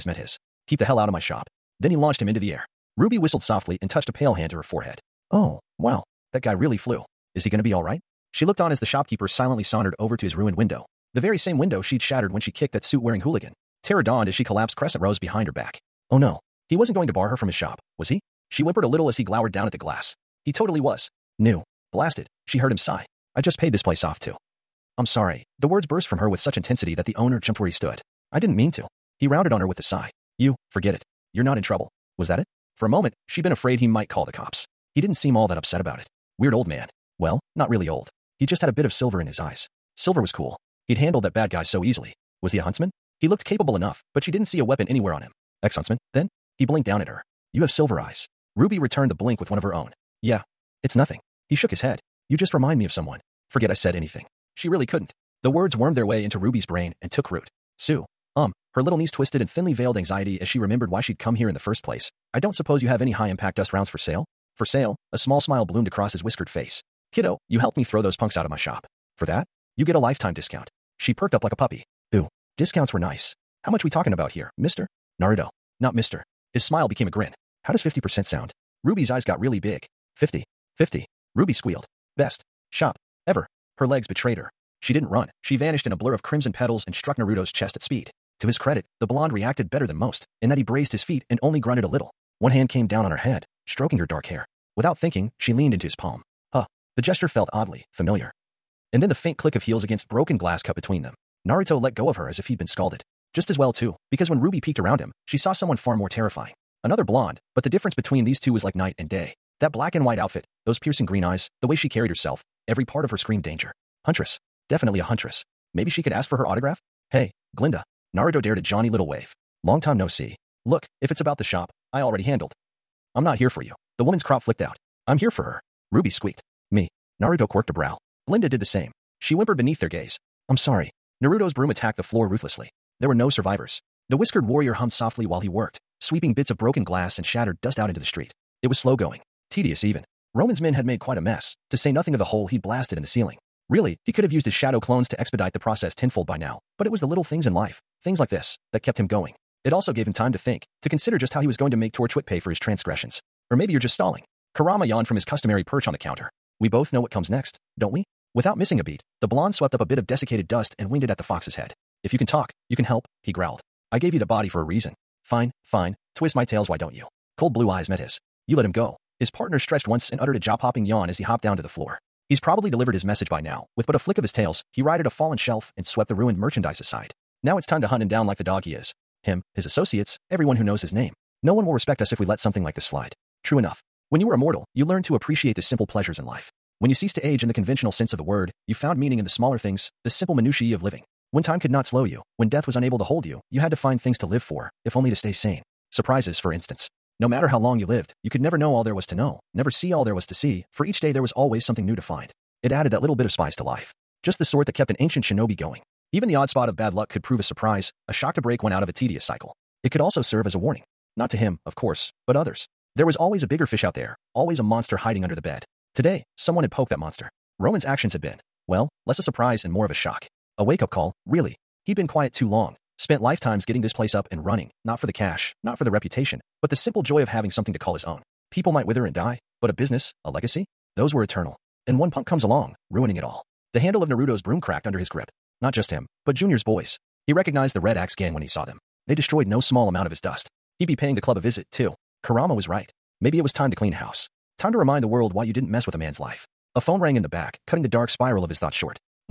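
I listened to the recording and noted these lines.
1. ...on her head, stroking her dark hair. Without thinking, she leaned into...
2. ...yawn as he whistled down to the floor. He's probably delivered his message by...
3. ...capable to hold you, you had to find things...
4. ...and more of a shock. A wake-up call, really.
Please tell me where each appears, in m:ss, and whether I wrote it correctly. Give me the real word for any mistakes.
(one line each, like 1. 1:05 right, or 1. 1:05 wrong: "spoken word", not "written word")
1. 1:33 right
2. 2:50 wrong: "hopped", not "whistled"
3. 3:12 wrong: "unable", not "capable"
4. 3:39 right.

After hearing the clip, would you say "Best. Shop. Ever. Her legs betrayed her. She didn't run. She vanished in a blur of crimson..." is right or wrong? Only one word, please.
right.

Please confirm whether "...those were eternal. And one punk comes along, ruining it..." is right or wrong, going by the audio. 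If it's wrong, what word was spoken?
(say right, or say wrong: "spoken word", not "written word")
right.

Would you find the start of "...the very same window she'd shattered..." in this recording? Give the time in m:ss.
0:11.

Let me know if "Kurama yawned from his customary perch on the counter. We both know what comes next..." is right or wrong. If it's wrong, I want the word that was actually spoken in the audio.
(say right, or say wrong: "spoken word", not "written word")
right.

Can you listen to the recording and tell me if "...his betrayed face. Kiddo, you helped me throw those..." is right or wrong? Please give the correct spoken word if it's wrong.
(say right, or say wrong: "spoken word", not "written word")
wrong: "whiskered", not "betrayed".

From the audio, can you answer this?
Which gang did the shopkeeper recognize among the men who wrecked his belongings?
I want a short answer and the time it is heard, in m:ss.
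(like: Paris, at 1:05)
Red Axe gang, at 3:57.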